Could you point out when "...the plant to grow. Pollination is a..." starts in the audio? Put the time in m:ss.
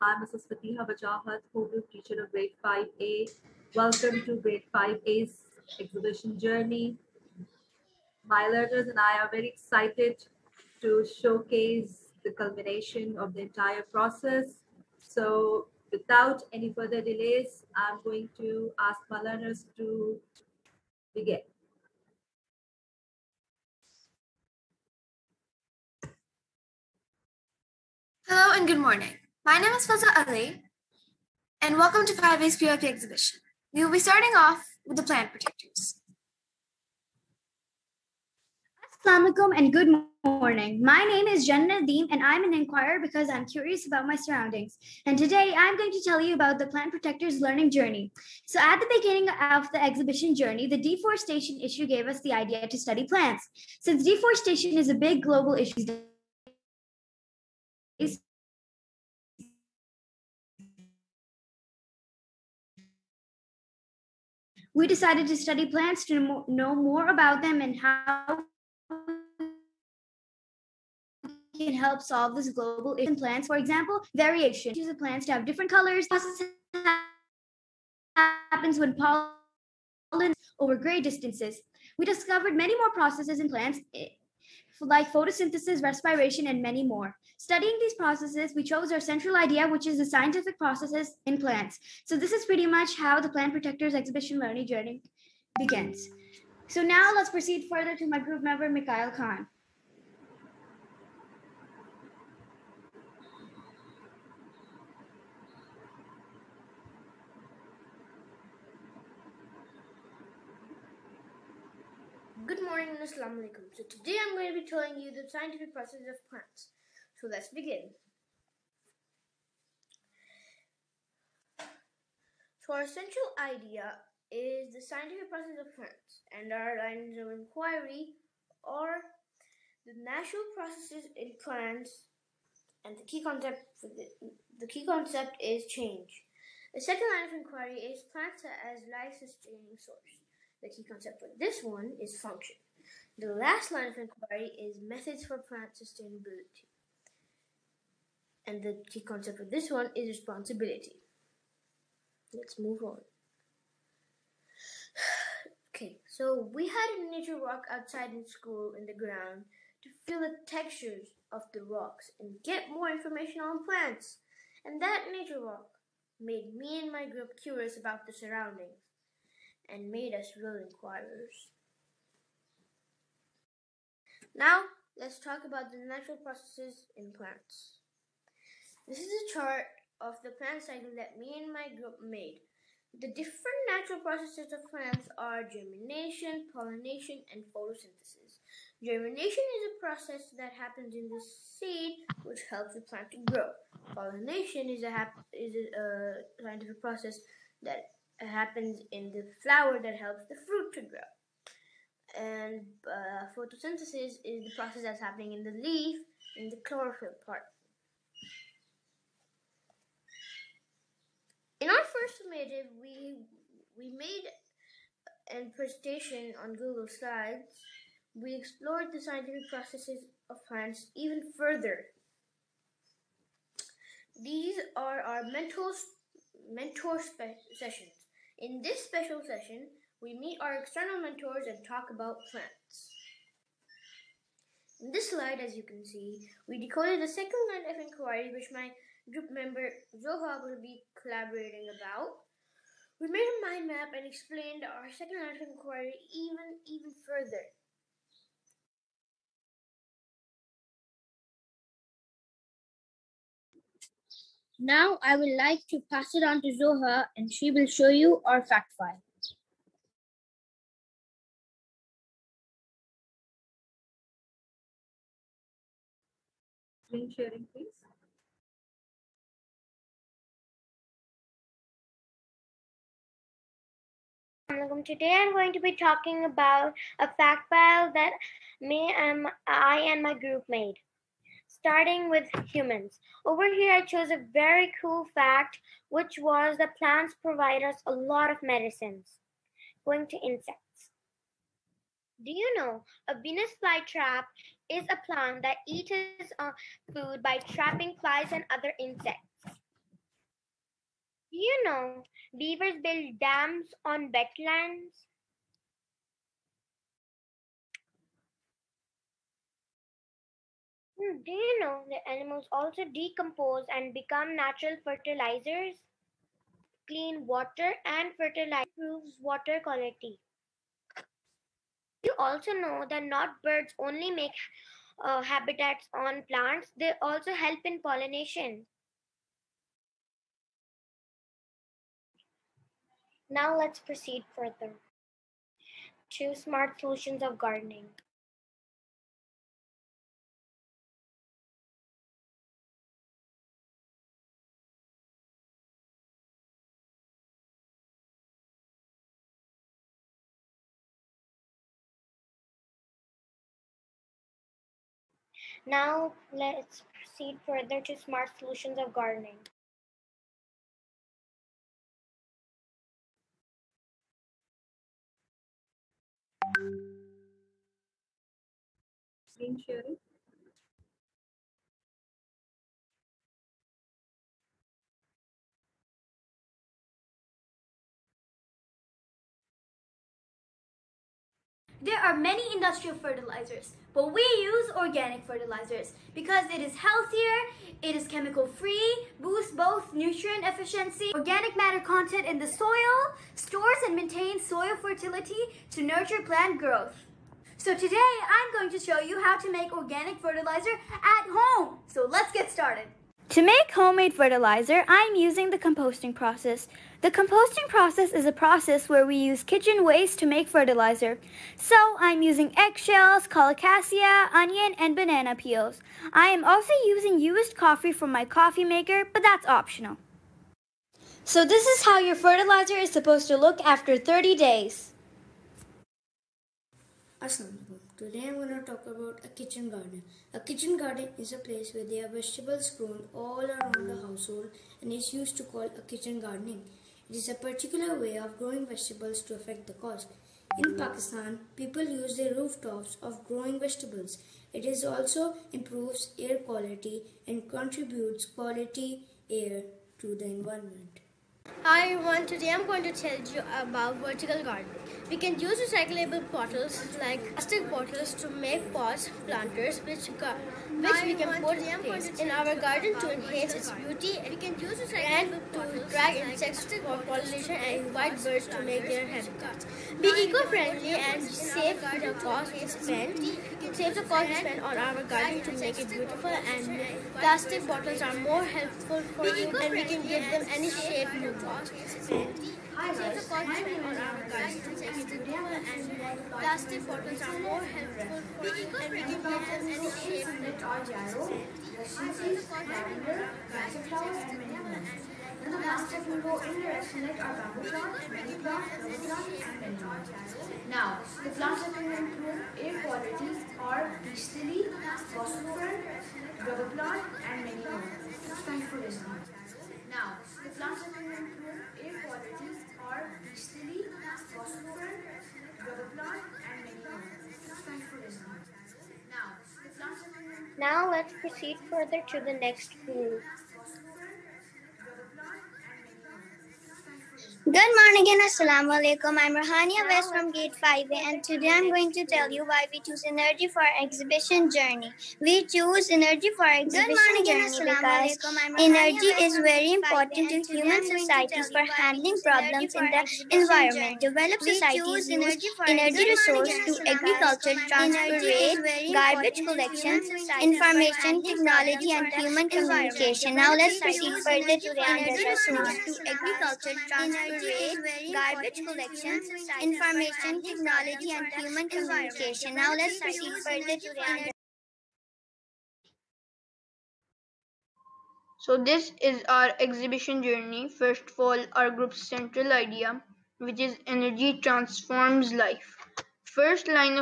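3:12.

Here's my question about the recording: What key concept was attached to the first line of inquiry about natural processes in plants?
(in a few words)
Change.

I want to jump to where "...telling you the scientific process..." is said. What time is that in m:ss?
1:54.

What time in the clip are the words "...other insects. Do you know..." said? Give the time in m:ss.
4:58.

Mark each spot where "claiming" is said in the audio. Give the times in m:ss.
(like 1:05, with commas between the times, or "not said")
not said.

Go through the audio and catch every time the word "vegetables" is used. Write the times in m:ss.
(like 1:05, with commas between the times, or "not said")
7:12, 7:18, 7:23.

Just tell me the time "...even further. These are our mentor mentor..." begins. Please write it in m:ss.
3:40.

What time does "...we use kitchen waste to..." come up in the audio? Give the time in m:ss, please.
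6:49.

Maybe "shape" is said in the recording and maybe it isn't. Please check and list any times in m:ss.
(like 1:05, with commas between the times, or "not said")
8:00, 8:10.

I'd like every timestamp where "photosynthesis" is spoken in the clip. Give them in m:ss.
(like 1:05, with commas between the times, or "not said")
1:25, 3:07, 3:23.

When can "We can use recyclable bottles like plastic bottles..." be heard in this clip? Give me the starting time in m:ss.
7:35.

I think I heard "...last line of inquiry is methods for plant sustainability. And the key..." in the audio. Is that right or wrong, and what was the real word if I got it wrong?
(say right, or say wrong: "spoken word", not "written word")
right.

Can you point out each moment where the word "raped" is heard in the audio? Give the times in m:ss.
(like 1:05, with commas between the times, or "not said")
not said.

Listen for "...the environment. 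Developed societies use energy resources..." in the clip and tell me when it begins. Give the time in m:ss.
9:02.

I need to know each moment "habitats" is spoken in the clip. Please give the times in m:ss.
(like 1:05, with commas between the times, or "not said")
5:25, 7:49.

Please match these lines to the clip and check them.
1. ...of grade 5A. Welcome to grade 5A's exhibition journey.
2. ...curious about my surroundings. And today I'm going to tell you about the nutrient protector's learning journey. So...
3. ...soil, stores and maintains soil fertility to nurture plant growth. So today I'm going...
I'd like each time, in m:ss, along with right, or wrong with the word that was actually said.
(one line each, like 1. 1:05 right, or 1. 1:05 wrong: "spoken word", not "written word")
1. 0:02 right
2. 0:43 wrong: "plant", not "nutrient"
3. 6:32 right.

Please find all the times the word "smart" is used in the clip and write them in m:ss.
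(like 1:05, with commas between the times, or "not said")
5:36, 5:57.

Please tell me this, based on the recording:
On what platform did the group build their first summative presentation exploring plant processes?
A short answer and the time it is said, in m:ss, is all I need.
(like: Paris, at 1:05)
Google Slides, at 3:36.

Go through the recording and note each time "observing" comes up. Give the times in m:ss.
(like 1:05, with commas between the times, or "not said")
not said.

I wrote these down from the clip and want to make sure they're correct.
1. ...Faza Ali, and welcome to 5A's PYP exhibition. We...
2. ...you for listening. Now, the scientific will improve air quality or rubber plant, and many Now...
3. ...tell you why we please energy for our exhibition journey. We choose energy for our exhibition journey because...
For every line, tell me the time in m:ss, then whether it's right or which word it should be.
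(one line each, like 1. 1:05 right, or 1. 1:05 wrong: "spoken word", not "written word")
1. 0:29 right
2. 8:28 wrong: "plastic", not "scientific"
3. 8:52 wrong: "choose", not "please".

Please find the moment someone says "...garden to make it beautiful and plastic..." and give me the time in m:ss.
7:55.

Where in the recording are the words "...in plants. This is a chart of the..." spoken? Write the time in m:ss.
2:56.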